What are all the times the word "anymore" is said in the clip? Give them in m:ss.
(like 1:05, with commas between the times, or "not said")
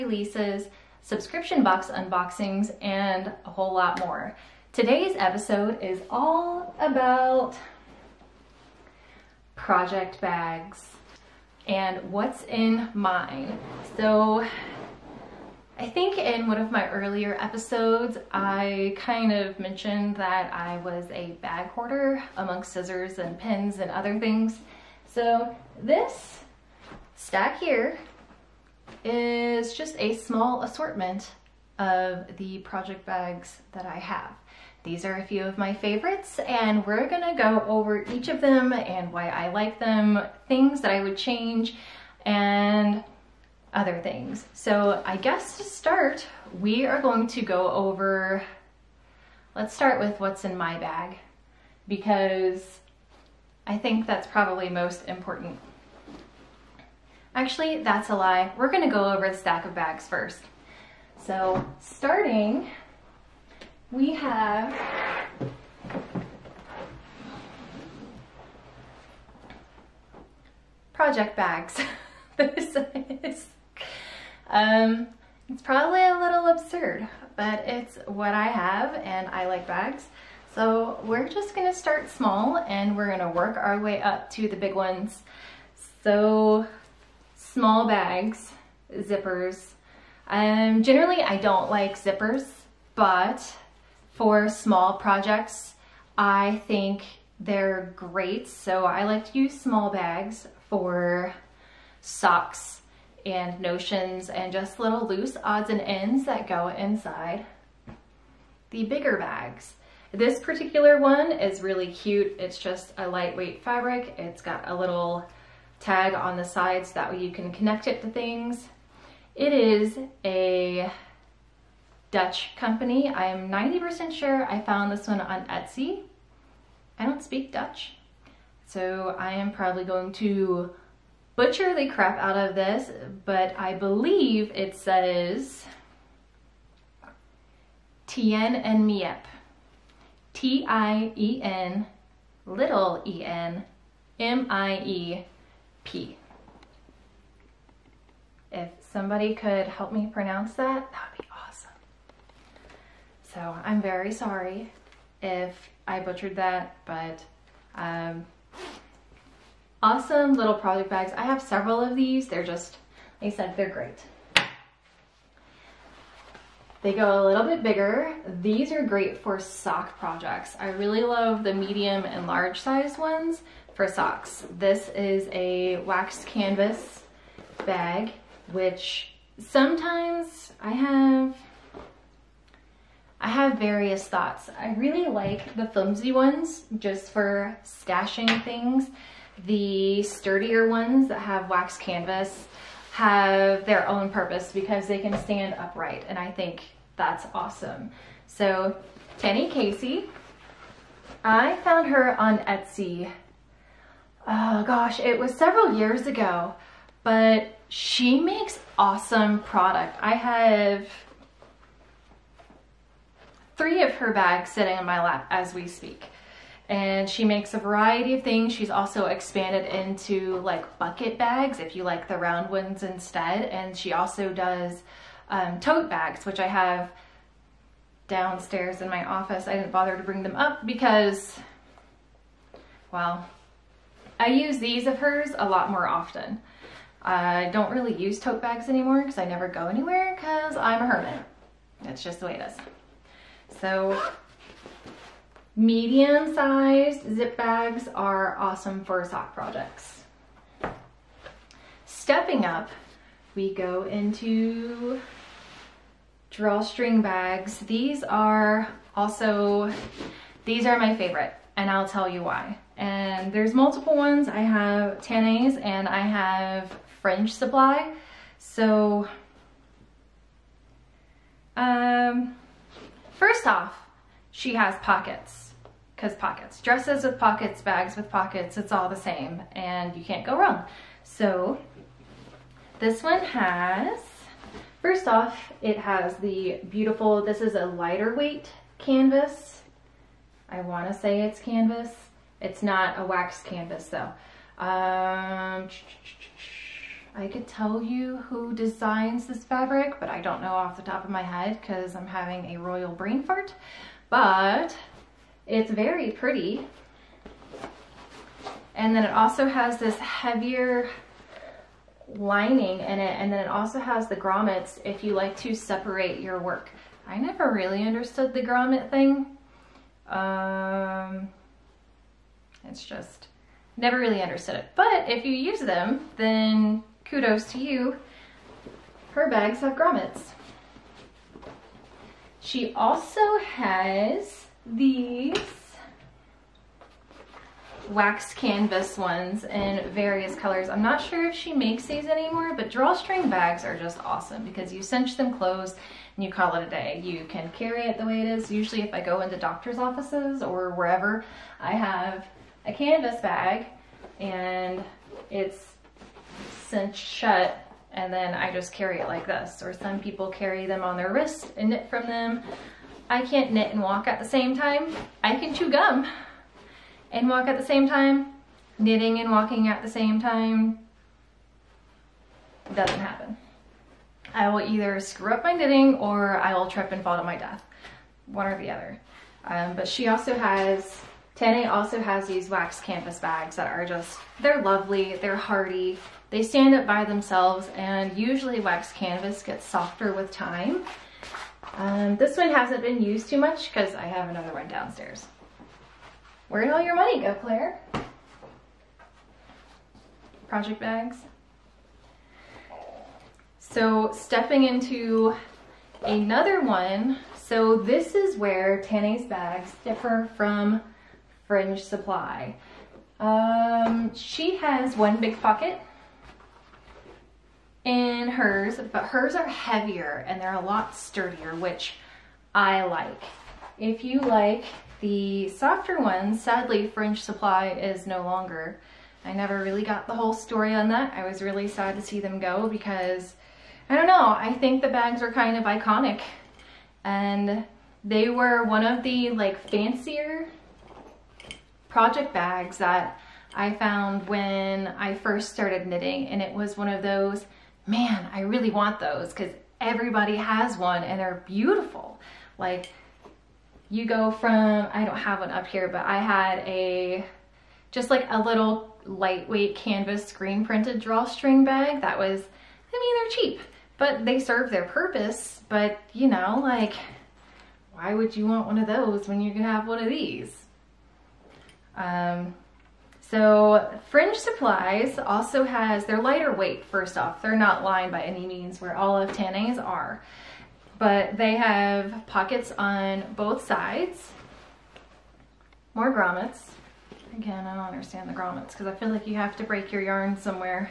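3:58, 5:42.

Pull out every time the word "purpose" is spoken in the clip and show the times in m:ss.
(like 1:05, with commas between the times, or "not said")
3:14, 7:44.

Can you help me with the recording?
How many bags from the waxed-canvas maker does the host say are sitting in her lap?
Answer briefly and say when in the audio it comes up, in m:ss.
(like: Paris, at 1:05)
3, at 3:33.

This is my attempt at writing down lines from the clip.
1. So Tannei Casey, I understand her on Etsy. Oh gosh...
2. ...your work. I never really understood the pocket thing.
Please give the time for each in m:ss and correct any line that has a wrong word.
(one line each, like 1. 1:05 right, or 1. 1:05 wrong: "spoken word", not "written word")
1. 3:18 wrong: "found", not "understand"
2. 5:16 wrong: "grommet", not "pocket".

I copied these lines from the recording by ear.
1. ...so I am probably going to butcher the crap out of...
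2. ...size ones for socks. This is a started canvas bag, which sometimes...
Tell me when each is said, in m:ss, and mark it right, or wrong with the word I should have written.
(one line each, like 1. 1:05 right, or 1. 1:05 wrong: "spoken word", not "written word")
1. 2:08 right
2. 2:52 wrong: "waxed", not "started".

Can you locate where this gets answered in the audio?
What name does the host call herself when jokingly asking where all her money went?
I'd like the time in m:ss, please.
6:37.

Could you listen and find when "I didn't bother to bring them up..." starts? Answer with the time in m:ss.
3:49.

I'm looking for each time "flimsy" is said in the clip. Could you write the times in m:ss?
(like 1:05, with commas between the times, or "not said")
3:05.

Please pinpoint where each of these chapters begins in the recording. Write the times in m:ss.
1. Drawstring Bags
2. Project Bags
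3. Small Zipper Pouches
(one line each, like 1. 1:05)
1. 4:12
2. 0:10
3. 1:04.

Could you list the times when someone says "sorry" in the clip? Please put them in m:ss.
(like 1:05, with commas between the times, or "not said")
2:34.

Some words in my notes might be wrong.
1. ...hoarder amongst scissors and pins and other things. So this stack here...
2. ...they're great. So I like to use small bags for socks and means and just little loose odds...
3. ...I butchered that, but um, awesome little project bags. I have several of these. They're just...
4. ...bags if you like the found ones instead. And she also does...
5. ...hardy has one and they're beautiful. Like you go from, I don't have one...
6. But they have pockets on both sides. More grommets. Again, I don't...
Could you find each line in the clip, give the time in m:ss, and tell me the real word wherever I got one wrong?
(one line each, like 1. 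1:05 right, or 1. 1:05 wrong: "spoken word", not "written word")
1. 0:21 right
2. 1:37 wrong: "notions", not "means"
3. 2:35 right
4. 3:41 wrong: "round", not "found"
5. 7:29 wrong: "everybody", not "hardy"
6. 8:00 right.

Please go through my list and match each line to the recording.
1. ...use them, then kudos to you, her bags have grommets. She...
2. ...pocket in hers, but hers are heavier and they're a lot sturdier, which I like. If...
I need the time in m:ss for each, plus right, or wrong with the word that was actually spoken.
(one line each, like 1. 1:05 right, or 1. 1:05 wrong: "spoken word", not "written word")
1. 5:25 right
2. 6:55 right.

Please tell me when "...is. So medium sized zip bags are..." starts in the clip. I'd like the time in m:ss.
4:02.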